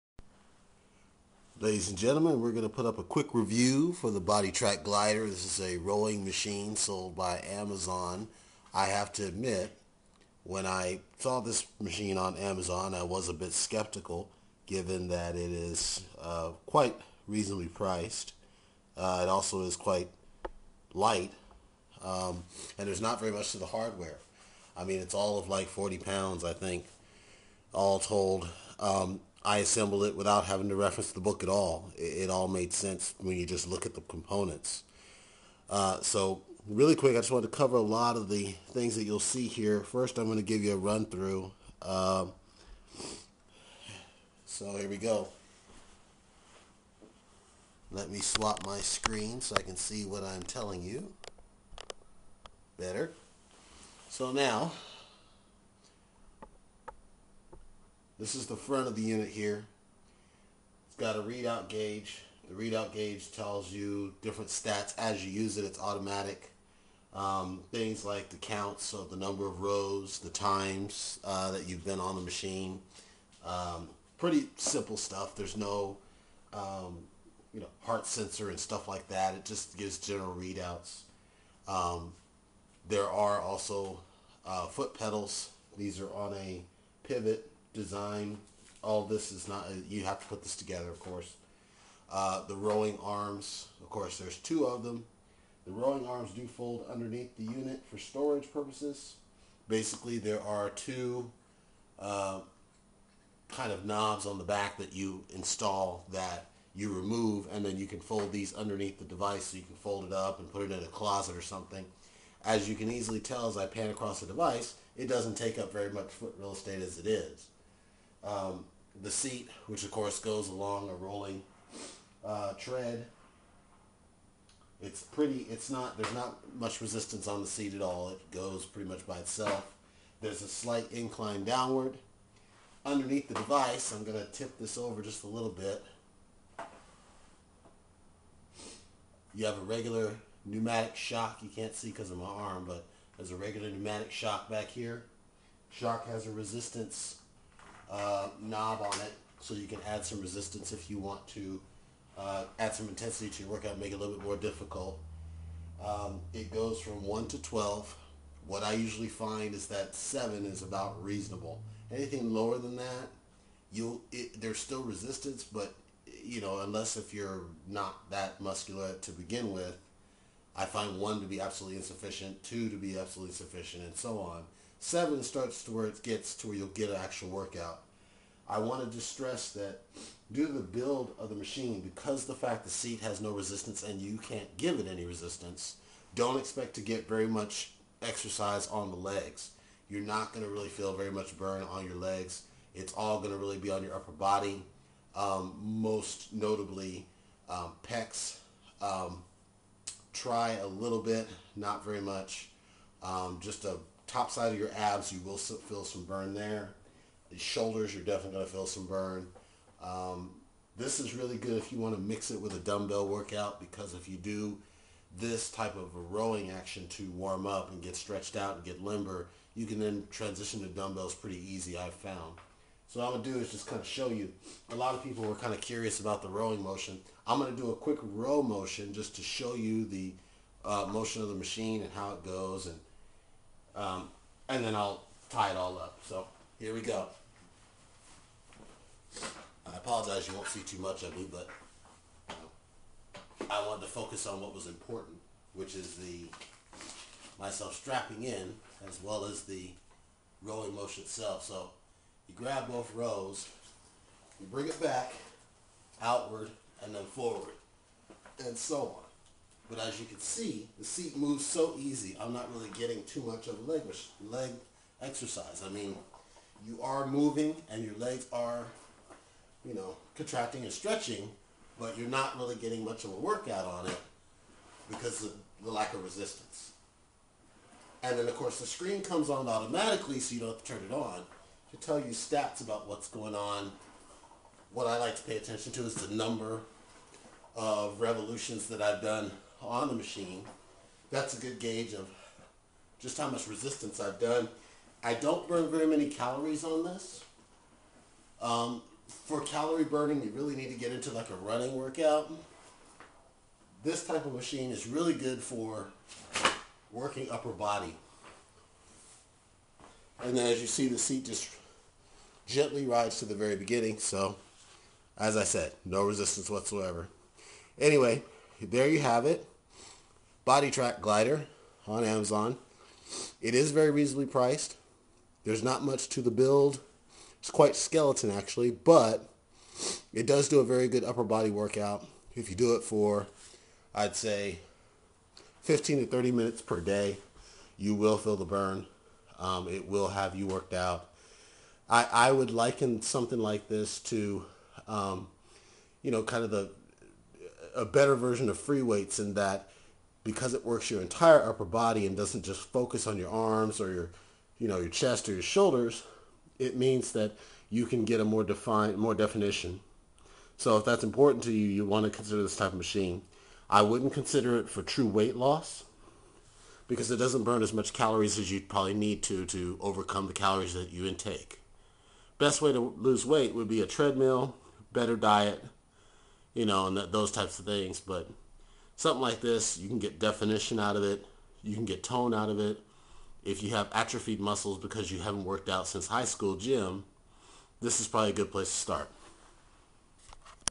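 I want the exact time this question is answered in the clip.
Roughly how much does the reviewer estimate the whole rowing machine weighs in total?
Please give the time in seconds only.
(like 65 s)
25 s.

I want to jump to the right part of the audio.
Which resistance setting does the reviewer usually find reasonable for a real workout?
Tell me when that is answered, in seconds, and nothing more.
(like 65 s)
159 s.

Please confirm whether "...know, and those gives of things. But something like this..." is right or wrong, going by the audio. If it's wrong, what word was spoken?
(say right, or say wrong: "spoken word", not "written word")
wrong: "types", not "gives".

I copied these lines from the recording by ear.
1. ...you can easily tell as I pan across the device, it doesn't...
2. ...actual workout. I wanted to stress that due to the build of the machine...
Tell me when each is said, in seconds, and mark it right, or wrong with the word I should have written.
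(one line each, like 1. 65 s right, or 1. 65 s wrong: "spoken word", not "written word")
1. 112 s right
2. 176 s right.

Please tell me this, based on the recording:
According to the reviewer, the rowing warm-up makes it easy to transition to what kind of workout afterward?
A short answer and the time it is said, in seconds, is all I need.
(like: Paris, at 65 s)
dumbbells, at 220 s.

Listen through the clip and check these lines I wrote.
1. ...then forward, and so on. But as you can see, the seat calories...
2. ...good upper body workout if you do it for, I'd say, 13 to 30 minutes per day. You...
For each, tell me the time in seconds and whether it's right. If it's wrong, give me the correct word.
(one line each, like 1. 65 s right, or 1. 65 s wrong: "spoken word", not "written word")
1. 256 s wrong: "moves", not "calories"
2. 330 s wrong: "15", not "13".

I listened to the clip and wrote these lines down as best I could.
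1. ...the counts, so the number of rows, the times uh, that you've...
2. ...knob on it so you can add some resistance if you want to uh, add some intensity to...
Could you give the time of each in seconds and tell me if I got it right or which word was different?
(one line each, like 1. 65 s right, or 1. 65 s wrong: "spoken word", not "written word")
1. 68 s right
2. 148 s right.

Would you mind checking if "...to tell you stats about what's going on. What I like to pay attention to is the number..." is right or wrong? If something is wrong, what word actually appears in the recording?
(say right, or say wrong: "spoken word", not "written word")
right.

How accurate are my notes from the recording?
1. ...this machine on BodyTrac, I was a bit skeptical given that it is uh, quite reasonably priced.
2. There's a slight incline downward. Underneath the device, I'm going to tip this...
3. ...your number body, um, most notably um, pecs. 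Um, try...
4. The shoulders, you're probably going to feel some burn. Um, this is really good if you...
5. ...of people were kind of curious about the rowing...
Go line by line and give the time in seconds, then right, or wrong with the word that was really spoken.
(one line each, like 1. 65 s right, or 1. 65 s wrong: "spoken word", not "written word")
1. 11 s wrong: "Amazon", not "BodyTrac"
2. 130 s right
3. 193 s wrong: "upper", not "number"
4. 207 s wrong: "definitely", not "probably"
5. 224 s right.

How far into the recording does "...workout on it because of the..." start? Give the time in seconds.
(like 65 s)
273 s.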